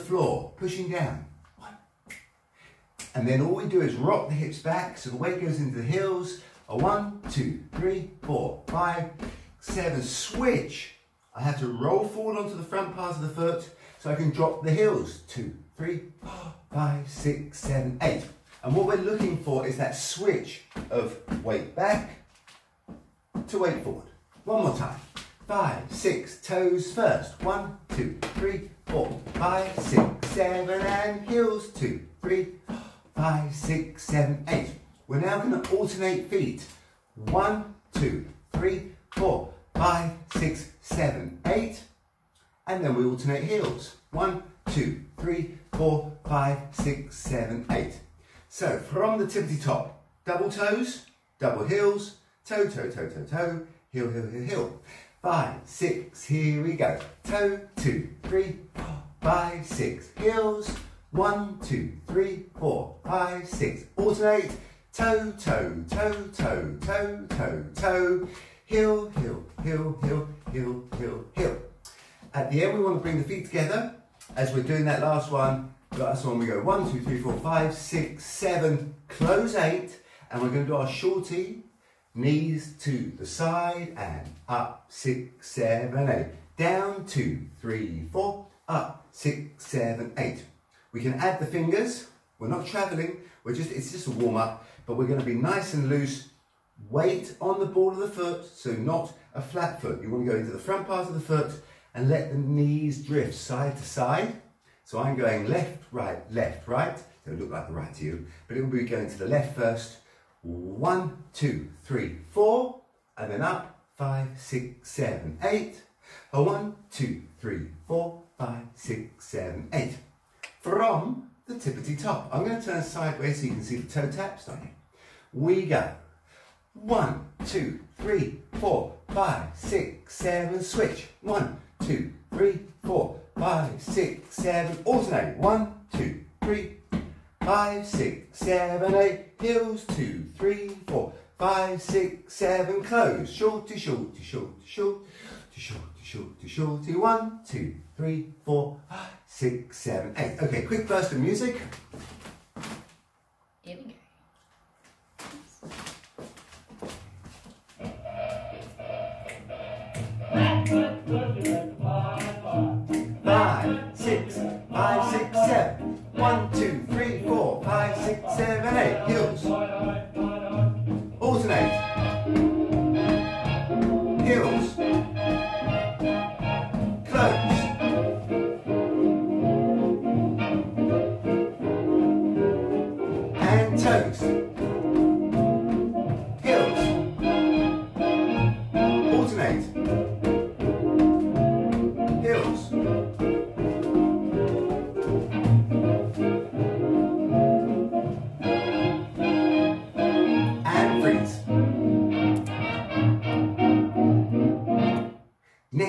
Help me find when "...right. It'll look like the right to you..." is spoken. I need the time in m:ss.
1:46.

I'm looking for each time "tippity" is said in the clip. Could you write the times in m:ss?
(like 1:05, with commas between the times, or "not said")
0:49, 2:01.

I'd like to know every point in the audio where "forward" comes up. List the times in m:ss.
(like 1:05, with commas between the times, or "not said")
0:12, 0:23.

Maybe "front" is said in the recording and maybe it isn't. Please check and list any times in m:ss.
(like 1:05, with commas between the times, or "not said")
0:12, 1:40.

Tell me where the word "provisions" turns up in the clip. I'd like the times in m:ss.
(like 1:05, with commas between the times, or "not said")
not said.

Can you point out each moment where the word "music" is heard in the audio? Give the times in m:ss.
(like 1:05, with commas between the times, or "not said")
2:31.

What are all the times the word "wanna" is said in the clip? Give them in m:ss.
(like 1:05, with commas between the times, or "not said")
1:40.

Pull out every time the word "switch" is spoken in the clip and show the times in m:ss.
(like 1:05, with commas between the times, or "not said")
0:10, 0:19, 2:10.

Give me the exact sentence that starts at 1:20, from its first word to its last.
And we're going to do our shorty Knees to the side and up, six, seven, eight.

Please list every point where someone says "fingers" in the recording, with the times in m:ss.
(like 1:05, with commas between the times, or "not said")
1:31.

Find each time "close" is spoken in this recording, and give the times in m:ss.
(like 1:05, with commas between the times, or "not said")
1:19, 2:22.